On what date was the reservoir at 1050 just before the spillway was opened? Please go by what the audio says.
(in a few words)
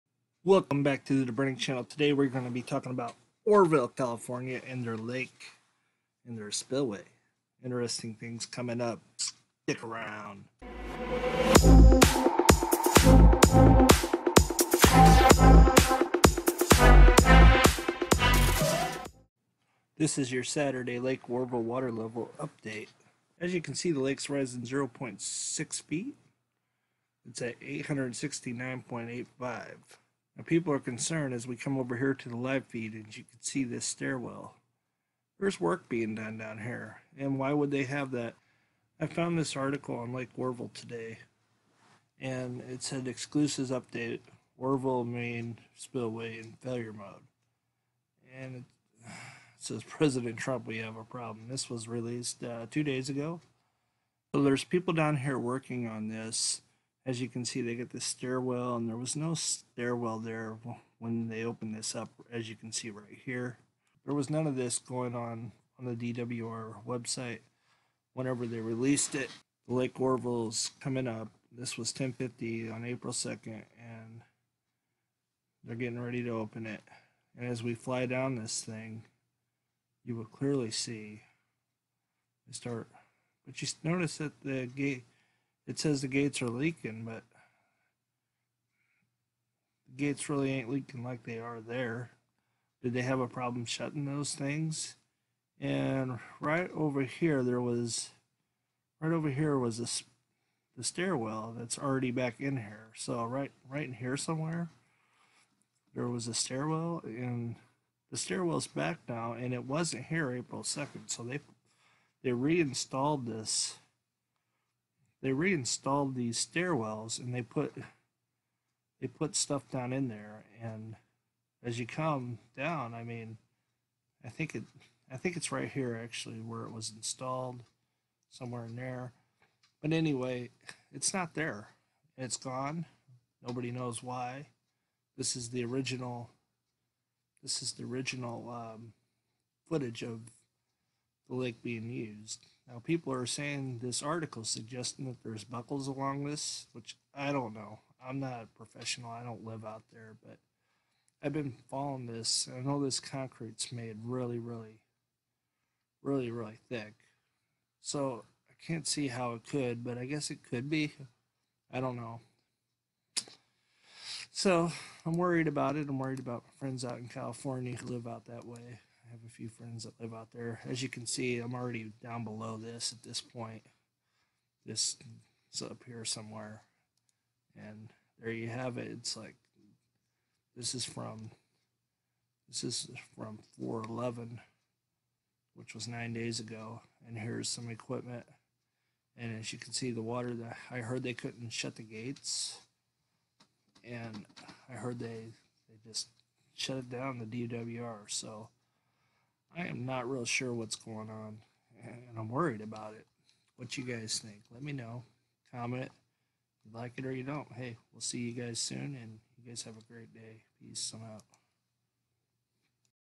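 April 2nd.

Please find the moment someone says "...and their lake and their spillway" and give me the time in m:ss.
0:04.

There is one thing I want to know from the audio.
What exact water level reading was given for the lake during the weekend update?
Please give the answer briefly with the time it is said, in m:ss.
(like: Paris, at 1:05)
869.85, at 0:27.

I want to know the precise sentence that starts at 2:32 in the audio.
I know this concrete's made really, really, really, really thick.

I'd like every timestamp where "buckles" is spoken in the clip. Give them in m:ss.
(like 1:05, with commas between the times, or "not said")
2:25.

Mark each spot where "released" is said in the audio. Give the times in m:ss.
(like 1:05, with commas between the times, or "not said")
0:51, 1:08.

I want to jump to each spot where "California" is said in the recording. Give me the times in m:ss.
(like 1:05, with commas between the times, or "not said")
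0:03, 2:47.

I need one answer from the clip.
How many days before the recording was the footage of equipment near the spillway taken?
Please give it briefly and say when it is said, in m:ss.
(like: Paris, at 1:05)
9 days, at 3:05.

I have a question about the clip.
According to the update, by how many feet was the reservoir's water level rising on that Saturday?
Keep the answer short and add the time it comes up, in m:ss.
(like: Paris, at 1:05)
0.6 feet, at 0:24.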